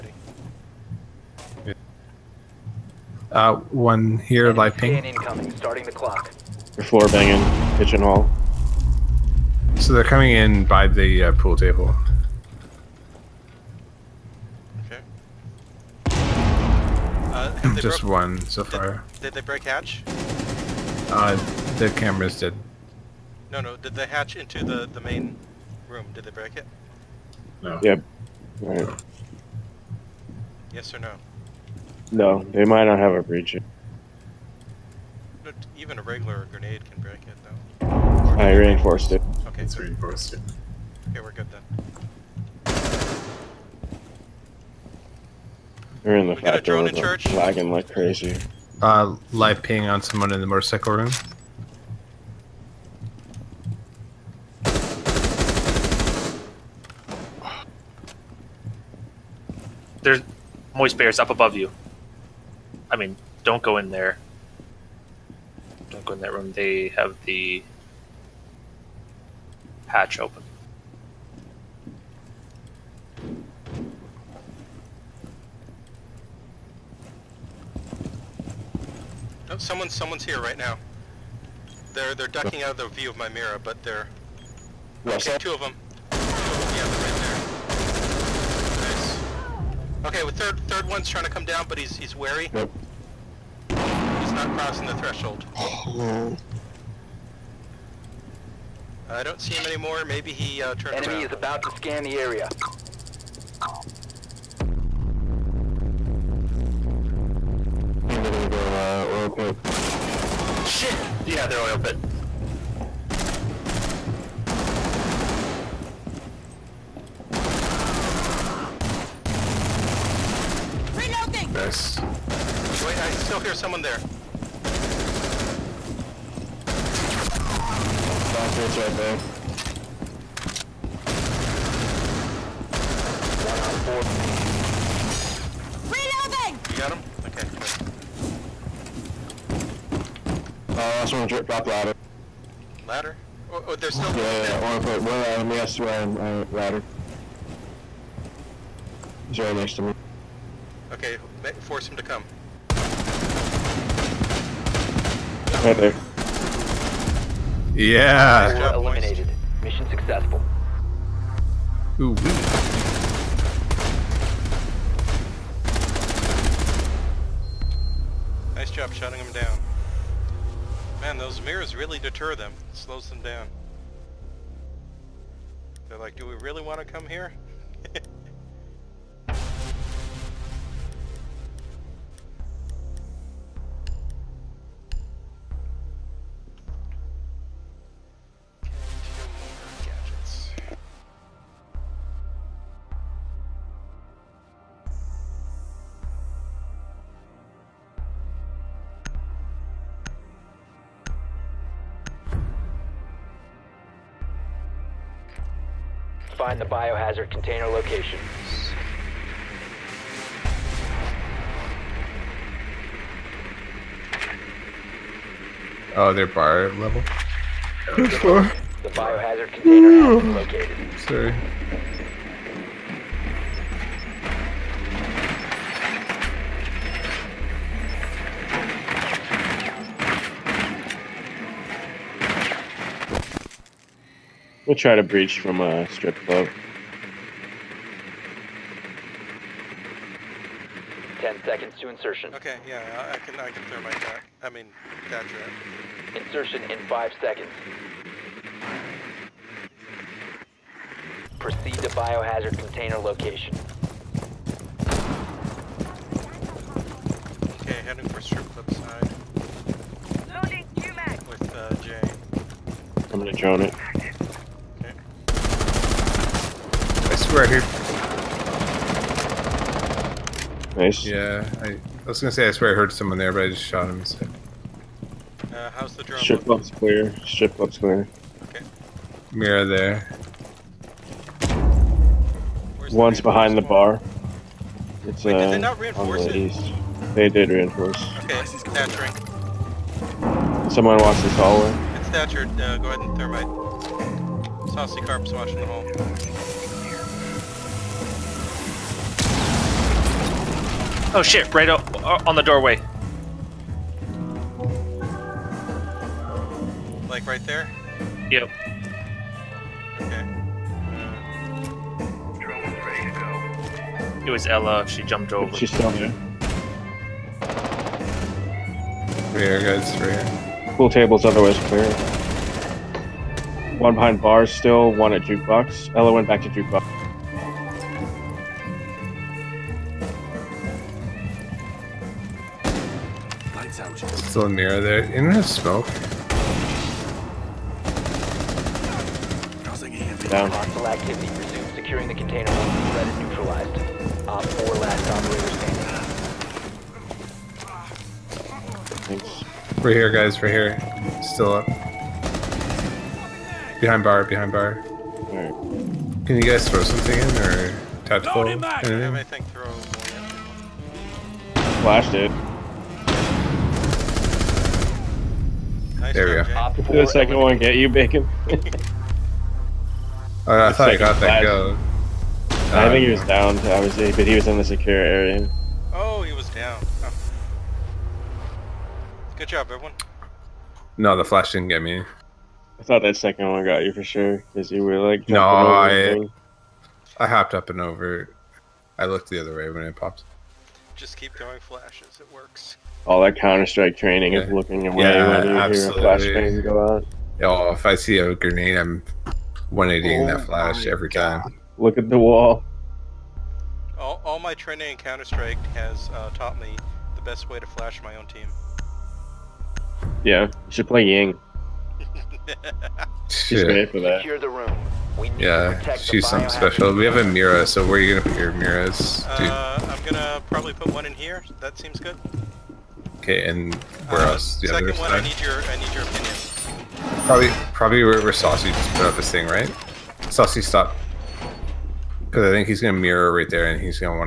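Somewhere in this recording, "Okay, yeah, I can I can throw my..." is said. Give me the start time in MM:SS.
04:02.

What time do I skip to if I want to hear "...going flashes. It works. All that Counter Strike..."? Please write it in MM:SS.
06:31.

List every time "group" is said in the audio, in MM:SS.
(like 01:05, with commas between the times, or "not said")
not said.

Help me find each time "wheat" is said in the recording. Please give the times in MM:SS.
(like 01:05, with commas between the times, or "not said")
not said.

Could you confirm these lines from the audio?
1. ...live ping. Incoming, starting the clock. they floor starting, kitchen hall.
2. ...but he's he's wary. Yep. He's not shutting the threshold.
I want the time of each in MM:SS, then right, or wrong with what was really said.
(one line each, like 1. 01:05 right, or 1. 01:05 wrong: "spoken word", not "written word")
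1. 00:04 wrong: "banging", not "starting"
2. 01:31 wrong: "crossing", not "shutting".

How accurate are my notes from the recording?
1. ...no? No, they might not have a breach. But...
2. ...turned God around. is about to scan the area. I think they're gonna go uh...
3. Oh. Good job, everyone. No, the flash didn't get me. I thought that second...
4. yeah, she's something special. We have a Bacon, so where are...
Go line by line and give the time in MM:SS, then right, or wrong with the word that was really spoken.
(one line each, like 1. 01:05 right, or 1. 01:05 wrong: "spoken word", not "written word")
1. 00:30 right
2. 01:40 wrong: "Enemy", not "God"
3. 06:17 right
4. 06:55 wrong: "Mira", not "Bacon".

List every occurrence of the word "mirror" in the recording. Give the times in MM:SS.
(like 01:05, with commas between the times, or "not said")
01:23, 02:51, 04:39, 05:34, 07:12.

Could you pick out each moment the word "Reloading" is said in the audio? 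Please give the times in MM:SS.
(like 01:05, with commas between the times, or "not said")
02:15.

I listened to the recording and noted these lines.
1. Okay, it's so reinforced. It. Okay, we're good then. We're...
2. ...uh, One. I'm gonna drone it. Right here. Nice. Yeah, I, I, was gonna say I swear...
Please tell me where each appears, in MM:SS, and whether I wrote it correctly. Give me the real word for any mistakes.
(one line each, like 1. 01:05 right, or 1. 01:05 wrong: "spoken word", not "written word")
1. 00:39 right
2. 04:21 wrong: "Jay", not "One".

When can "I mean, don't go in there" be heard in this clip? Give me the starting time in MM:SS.
01:02.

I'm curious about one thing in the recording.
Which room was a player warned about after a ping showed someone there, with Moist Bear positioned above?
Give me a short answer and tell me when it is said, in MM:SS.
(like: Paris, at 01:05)
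Motorcycle room, at 00:50.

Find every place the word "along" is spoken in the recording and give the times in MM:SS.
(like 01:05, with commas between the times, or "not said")
not said.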